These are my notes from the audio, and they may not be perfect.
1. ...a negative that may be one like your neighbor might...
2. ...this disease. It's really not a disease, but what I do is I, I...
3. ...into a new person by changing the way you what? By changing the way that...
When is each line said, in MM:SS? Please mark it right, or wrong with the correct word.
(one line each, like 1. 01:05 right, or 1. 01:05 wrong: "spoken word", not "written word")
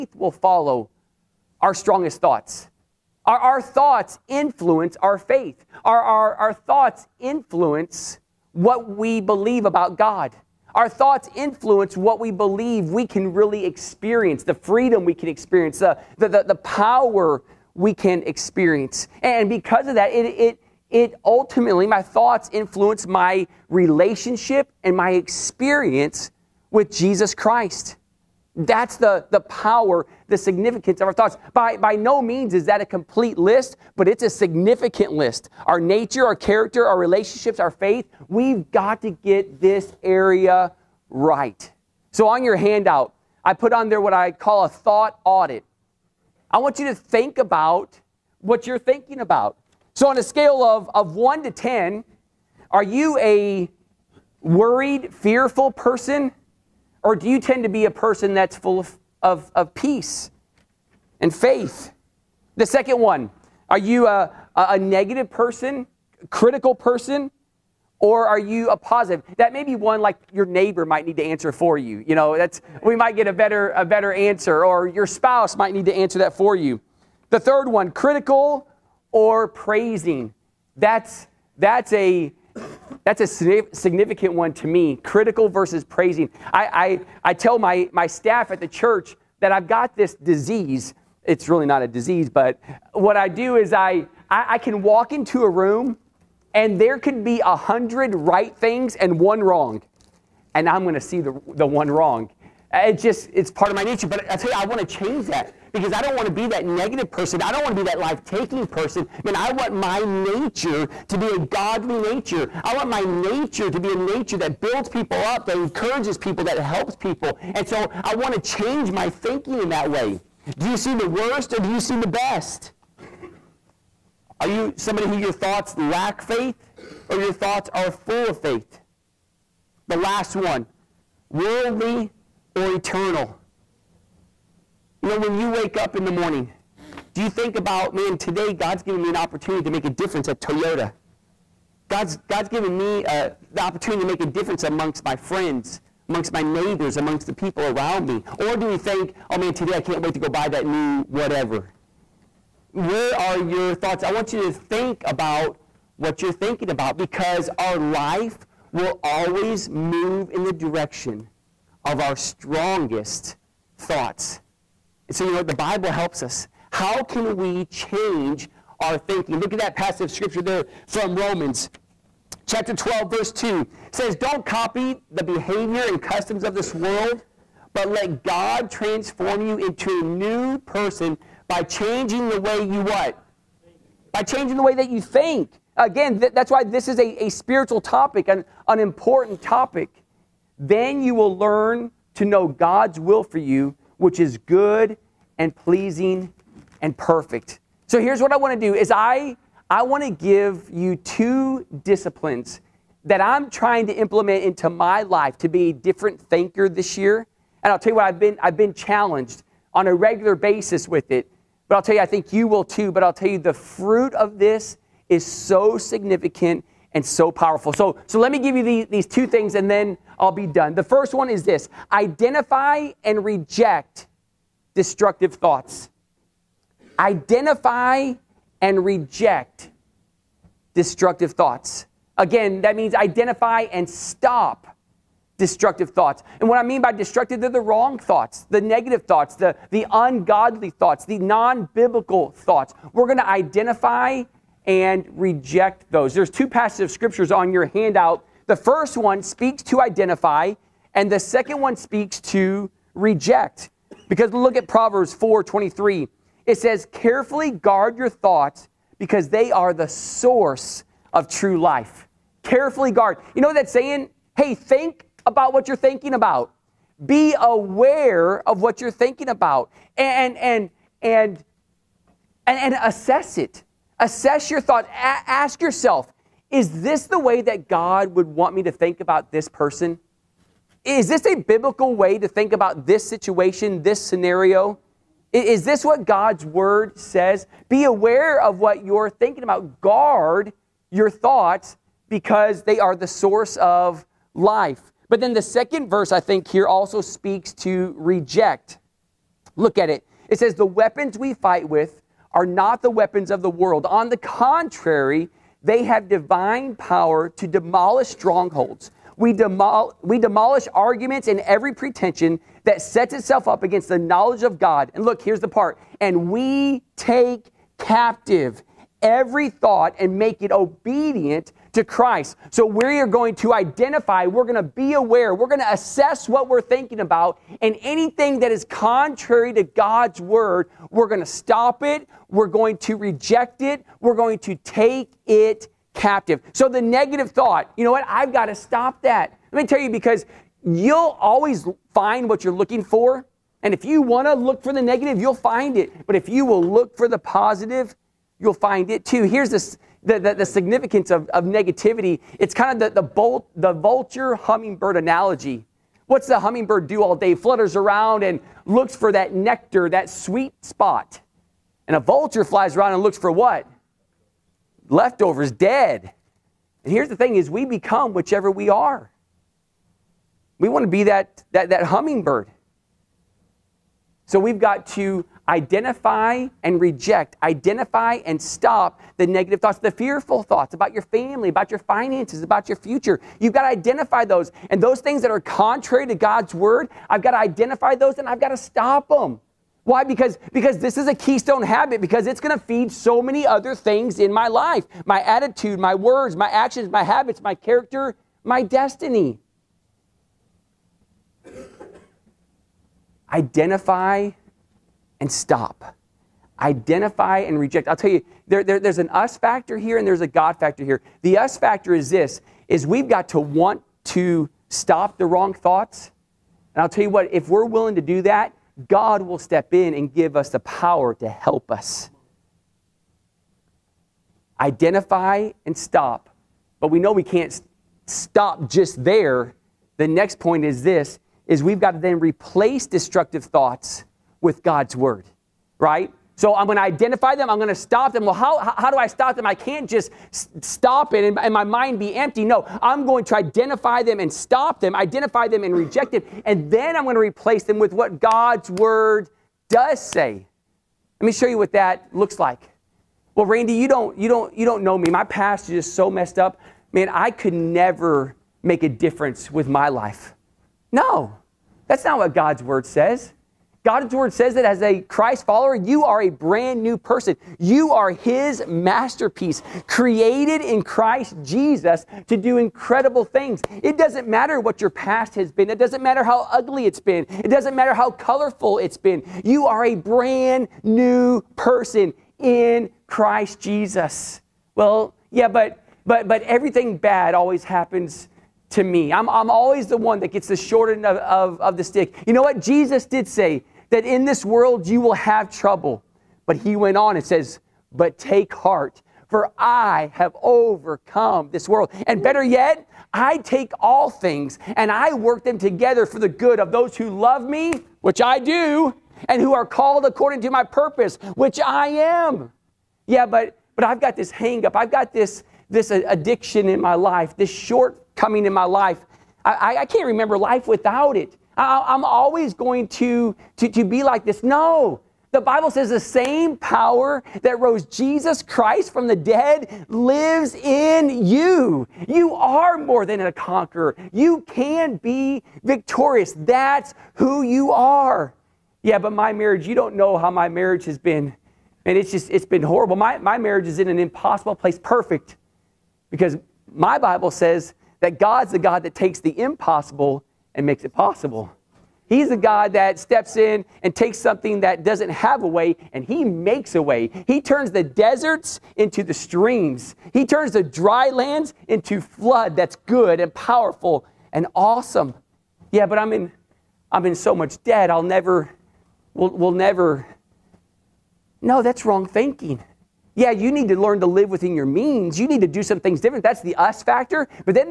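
1. 01:08 wrong: "positive", not "negative"
2. 01:29 right
3. 02:59 right.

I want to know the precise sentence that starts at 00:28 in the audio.
That's the, the power, the significance of our thoughts.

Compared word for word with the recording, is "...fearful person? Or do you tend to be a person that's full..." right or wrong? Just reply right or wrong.
right.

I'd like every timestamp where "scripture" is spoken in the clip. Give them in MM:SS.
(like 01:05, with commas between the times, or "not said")
02:50, 04:06.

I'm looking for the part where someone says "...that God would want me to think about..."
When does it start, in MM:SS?
04:37.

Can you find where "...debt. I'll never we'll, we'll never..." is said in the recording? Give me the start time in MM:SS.
09:27.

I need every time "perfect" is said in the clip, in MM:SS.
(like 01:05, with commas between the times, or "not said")
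03:16, 09:04.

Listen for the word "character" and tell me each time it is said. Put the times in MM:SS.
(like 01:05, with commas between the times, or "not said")
00:36, 06:37.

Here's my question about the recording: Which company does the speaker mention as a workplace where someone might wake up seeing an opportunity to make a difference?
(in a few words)
Toyota.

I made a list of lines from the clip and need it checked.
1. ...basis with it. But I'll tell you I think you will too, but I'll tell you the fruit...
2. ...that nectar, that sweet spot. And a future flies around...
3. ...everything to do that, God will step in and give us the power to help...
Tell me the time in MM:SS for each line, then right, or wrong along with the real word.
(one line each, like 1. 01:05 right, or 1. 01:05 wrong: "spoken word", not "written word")
1. 03:30 right
2. 05:59 wrong: "vulture", not "future"
3. 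06:57 wrong: "willing", not "everything".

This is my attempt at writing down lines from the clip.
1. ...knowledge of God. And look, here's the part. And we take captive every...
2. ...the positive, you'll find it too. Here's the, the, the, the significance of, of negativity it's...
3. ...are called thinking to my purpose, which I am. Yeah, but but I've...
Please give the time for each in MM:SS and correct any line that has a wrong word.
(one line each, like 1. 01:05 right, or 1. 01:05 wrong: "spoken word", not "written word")
1. 05:13 right
2. 05:47 right
3. 08:29 wrong: "according", not "thinking".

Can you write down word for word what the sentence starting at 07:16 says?
So I'm going to identify them.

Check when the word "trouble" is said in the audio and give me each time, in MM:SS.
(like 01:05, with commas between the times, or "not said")
08:15.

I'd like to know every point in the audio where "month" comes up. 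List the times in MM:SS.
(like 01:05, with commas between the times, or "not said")
not said.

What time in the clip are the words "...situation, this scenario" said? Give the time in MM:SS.
04:43.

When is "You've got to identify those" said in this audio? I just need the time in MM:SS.
06:23.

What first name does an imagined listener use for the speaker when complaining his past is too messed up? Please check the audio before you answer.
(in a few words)
Randy.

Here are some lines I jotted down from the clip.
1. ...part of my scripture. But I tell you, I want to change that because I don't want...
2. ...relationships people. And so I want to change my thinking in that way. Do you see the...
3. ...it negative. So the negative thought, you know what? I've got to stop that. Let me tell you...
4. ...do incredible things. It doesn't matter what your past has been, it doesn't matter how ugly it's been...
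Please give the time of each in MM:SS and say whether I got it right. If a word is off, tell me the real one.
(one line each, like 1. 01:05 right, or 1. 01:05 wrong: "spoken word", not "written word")
1. 01:43 wrong: "nature", not "scripture"
2. 01:56 wrong: "helps", not "relationships"
3. 05:35 wrong: "captive", not "negative"
4. 07:52 right.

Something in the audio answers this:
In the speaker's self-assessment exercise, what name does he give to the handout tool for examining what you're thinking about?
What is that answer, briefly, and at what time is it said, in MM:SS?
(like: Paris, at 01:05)
Thought audit, at 00:44.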